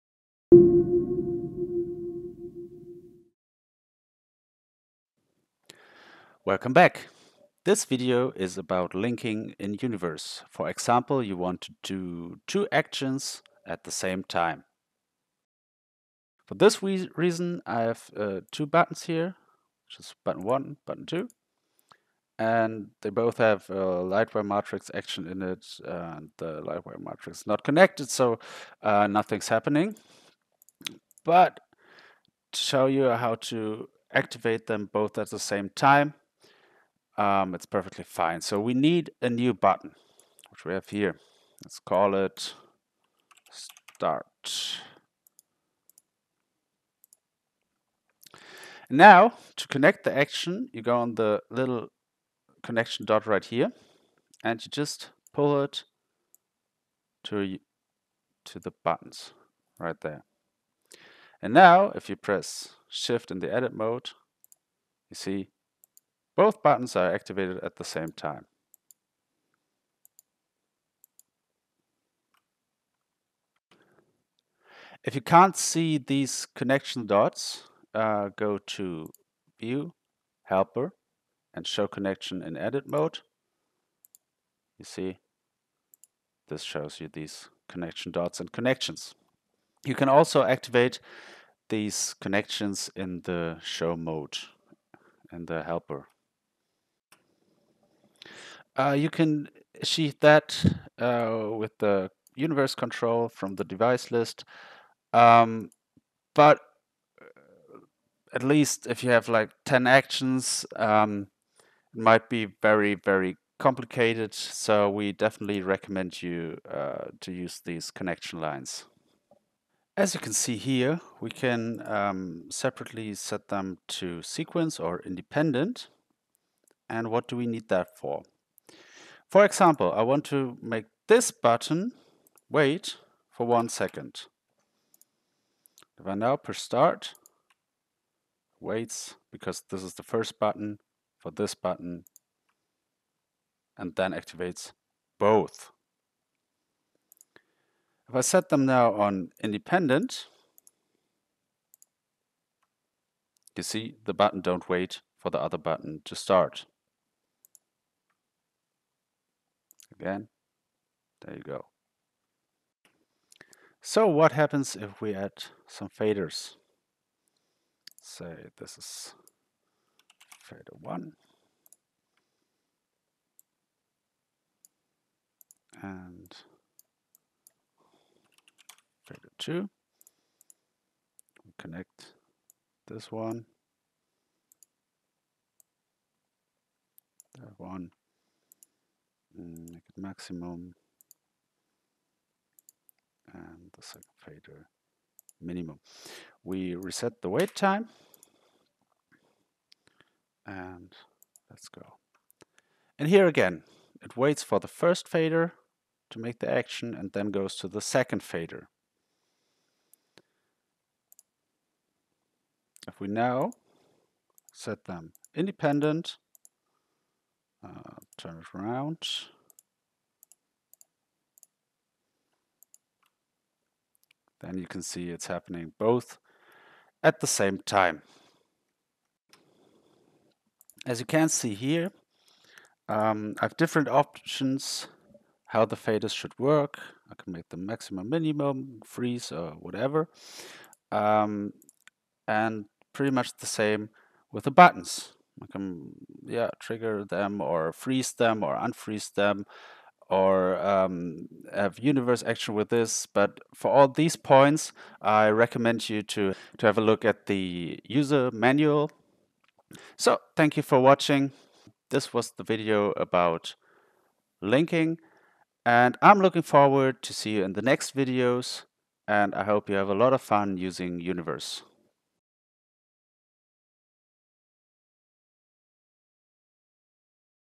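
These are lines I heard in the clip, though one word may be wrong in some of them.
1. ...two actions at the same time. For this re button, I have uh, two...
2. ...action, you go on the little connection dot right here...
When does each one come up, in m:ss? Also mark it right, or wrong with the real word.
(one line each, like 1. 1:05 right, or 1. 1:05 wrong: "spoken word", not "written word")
1. 0:12 wrong: "reason", not "button"
2. 0:50 right.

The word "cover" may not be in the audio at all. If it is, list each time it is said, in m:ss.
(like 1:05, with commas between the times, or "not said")
not said.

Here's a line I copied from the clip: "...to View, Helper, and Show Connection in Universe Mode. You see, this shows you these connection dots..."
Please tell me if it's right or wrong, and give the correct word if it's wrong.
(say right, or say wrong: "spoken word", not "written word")
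wrong: "Edit", not "Universe".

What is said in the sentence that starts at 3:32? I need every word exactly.
If we now set them independent, turn it around.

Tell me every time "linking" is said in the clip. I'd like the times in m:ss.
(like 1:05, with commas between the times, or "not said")
0:08, 4:24.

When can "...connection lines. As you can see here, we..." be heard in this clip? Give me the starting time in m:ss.
1:57.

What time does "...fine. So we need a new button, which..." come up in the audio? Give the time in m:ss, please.
0:38.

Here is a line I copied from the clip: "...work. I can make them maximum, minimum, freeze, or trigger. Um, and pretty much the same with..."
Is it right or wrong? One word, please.
wrong.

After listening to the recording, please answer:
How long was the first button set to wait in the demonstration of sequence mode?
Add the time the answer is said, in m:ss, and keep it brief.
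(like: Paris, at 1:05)
1 second, at 2:13.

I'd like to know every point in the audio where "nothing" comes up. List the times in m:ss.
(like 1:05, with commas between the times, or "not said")
0:29.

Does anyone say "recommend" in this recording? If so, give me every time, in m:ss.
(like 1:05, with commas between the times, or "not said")
1:55, 4:15.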